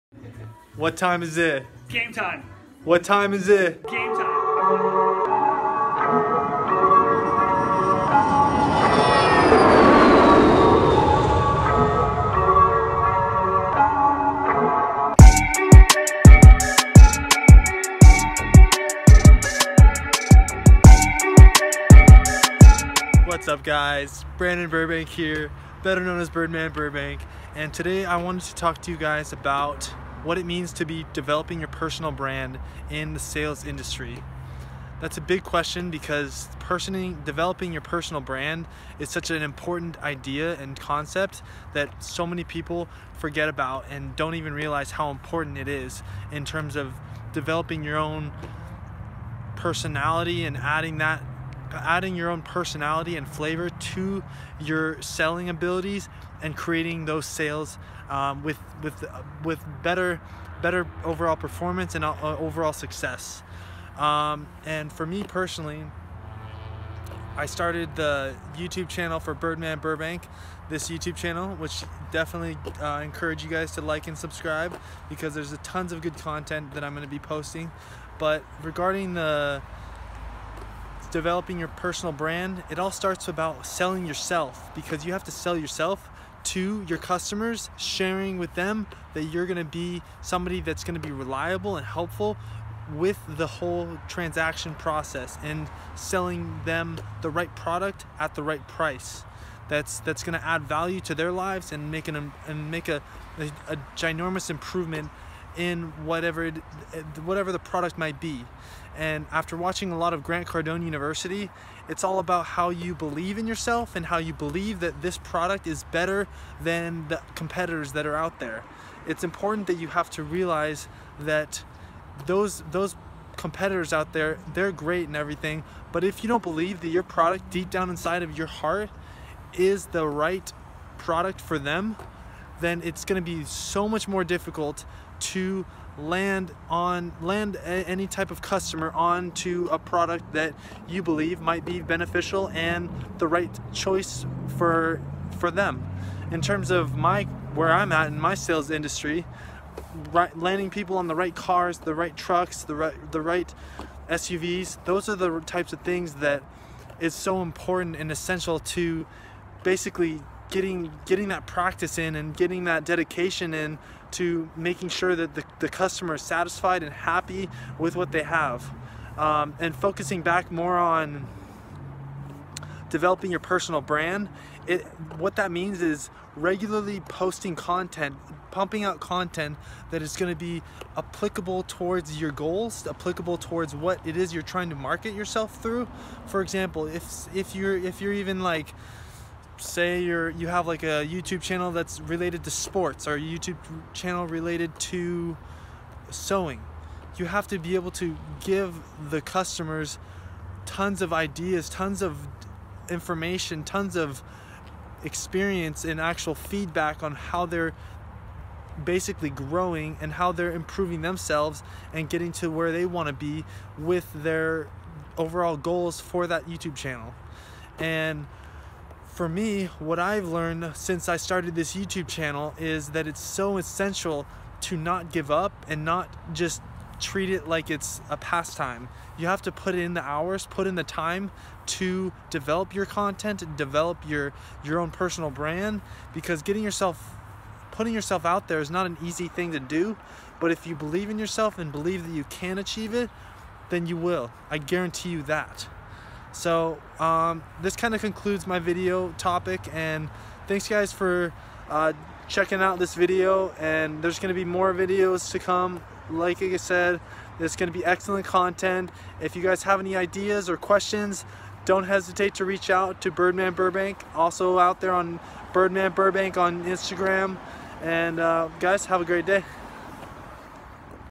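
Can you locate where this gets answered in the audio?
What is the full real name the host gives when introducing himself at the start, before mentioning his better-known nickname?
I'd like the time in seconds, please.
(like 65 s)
24 s.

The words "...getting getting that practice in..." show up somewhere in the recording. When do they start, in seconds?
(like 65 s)
160 s.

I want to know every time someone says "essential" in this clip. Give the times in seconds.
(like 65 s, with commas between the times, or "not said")
158 s, 223 s.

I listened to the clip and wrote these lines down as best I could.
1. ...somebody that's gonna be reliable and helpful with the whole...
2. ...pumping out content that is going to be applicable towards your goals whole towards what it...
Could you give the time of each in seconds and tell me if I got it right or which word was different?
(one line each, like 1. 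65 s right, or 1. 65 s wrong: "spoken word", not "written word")
1. 90 s right
2. 178 s wrong: "applicable", not "whole".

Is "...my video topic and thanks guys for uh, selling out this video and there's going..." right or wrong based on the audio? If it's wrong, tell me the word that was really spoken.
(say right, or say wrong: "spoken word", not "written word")
wrong: "checking", not "selling".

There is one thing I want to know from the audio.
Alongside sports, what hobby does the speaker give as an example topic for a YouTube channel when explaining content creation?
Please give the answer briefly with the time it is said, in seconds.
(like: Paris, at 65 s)
Sewing, at 196 s.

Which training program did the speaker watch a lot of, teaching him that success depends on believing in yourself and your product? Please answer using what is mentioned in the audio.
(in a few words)
Grant Cardone University.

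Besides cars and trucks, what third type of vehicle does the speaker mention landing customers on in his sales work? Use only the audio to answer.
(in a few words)
SUVs.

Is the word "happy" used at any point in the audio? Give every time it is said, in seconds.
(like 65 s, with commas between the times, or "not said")
166 s.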